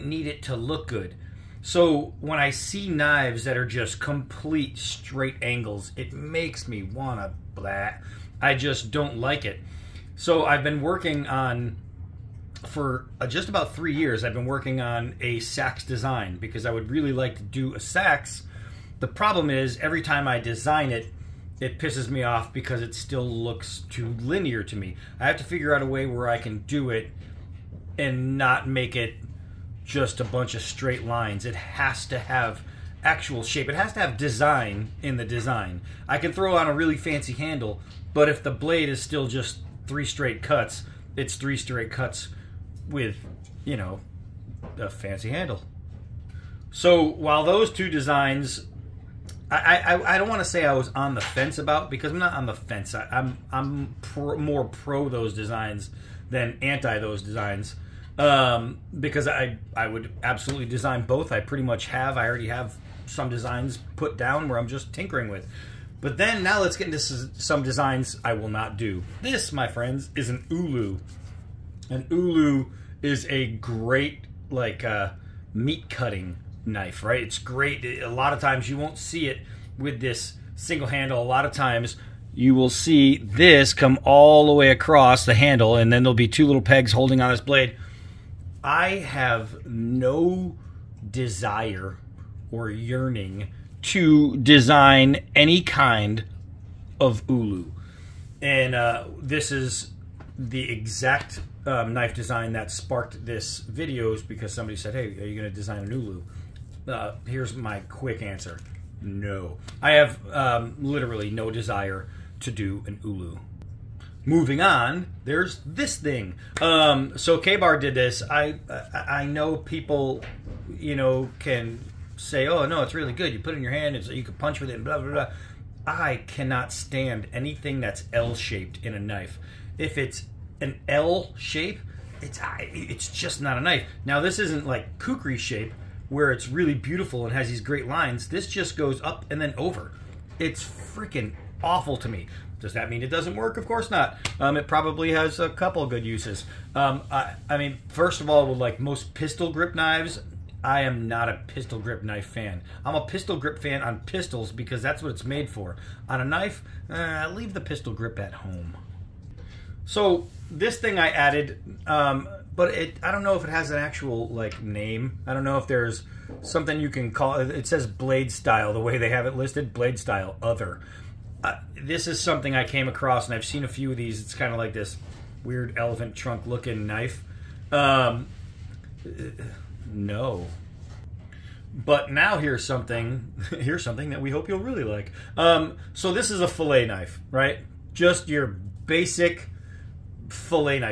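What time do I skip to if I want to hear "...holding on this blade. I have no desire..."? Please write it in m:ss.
1:26.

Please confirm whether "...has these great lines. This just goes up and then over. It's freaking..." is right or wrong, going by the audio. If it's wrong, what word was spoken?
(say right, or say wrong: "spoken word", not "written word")
right.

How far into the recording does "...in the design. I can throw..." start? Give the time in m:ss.
0:35.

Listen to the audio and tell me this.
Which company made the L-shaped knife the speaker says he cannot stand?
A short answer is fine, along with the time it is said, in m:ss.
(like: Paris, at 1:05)
KA-BAR, at 1:57.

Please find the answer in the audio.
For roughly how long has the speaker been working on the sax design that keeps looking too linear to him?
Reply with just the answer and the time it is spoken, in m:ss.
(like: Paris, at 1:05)
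3 years, at 0:13.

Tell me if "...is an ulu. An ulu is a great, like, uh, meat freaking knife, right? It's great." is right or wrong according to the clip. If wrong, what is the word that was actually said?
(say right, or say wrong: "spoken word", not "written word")
wrong: "cutting", not "freaking".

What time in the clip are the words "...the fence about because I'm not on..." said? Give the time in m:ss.
0:51.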